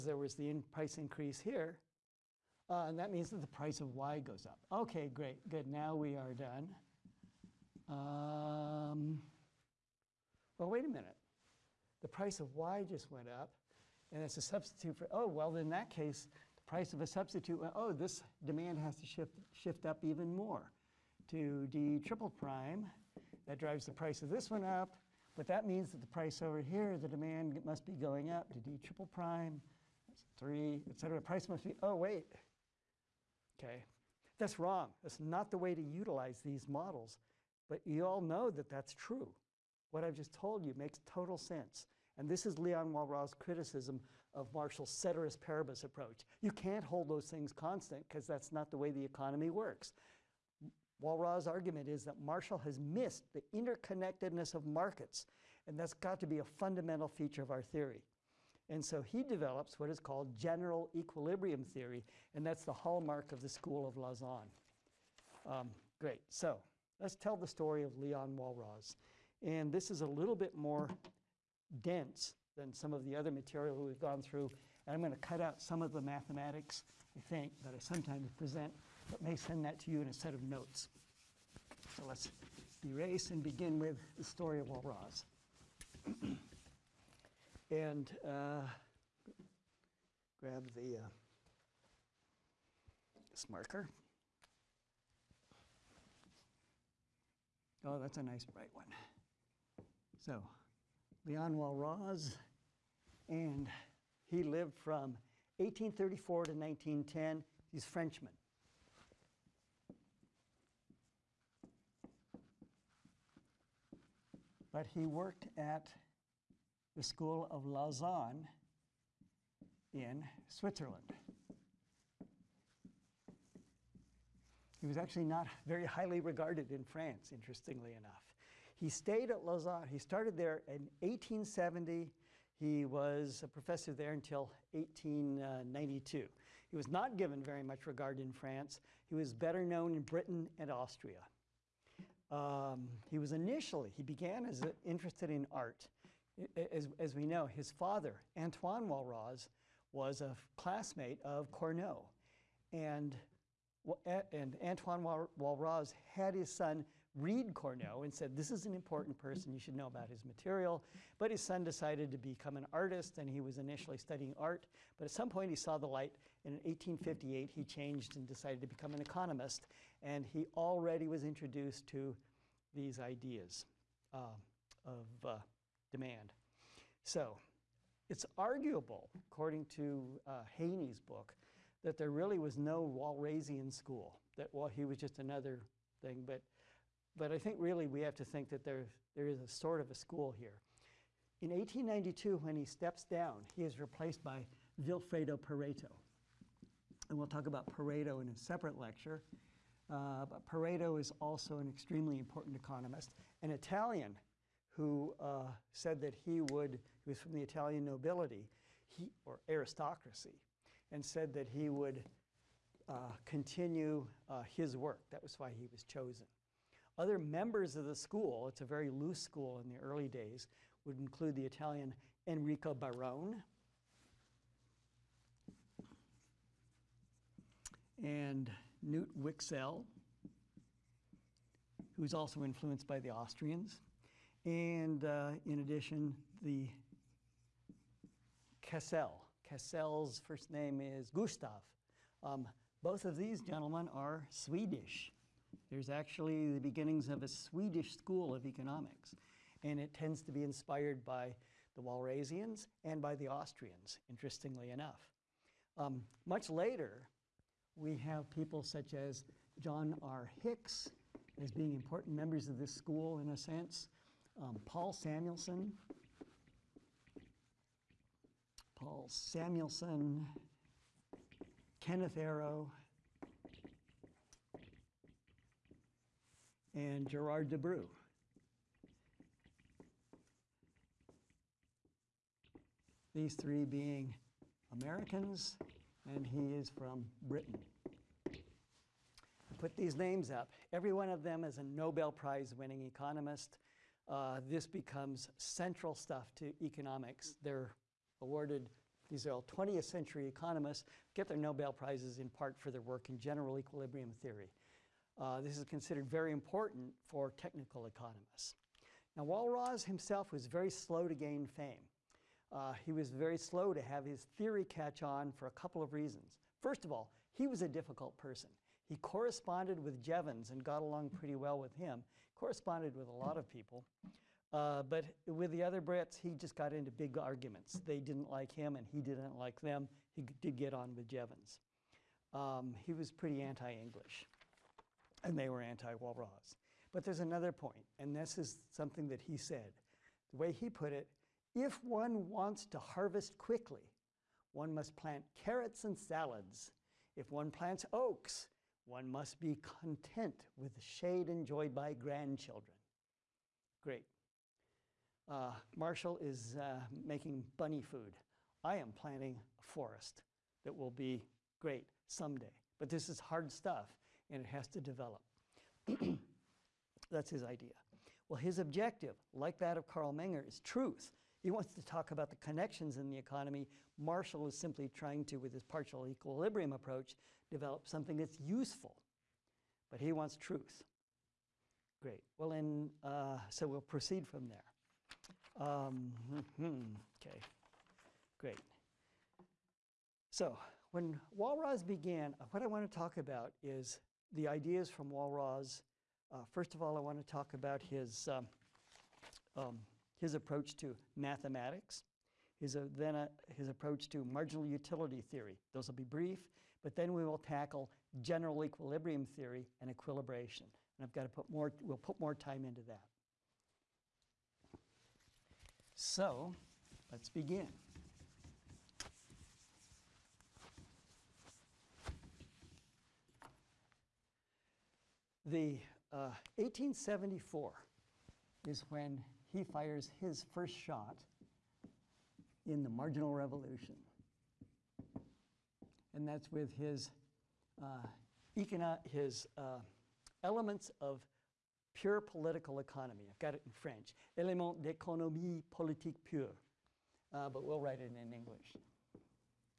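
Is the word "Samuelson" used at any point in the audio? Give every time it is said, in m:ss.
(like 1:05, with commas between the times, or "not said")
4:24, 4:29.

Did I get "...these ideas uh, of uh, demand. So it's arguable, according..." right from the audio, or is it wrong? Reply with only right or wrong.
right.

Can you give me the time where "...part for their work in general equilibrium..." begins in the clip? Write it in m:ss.
5:02.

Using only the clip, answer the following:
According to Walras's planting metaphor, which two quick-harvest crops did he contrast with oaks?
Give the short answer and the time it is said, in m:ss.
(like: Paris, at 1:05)
Carrots and salads, at 5:45.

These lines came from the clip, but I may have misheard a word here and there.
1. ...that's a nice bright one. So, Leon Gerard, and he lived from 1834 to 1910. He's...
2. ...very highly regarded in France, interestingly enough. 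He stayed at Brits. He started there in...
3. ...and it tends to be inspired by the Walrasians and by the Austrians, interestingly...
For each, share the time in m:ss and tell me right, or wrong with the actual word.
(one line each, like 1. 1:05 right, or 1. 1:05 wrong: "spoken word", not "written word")
1. 1:37 wrong: "Walras", not "Gerard"
2. 2:05 wrong: "Lausanne", not "Brits"
3. 4:09 right.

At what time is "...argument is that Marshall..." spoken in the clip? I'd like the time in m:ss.
0:51.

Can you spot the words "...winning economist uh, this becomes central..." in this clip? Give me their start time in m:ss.
4:52.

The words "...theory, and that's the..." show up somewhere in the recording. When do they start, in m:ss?
1:01.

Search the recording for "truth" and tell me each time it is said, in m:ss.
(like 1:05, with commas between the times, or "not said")
6:10, 6:20.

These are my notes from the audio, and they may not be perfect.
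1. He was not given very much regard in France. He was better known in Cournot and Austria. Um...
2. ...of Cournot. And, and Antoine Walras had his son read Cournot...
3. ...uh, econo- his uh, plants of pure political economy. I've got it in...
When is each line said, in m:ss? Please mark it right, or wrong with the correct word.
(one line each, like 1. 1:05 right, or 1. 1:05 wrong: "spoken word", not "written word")
1. 2:16 wrong: "Britain", not "Cournot"
2. 2:31 right
3. 7:17 wrong: "elements", not "plants".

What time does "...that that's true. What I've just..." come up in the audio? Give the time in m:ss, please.
0:38.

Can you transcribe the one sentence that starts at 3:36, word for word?
Other members of the school, it's a very loose school in the early days, would include the Italian Enrico Barone.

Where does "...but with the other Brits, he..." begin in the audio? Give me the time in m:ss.
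5:24.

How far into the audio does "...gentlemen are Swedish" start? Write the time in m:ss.
4:03.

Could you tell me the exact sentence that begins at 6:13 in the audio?
Marshall is simply trying to, with his partial equilibrium approach, develop something that's useful.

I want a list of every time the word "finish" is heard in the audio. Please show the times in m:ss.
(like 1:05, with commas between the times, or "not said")
not said.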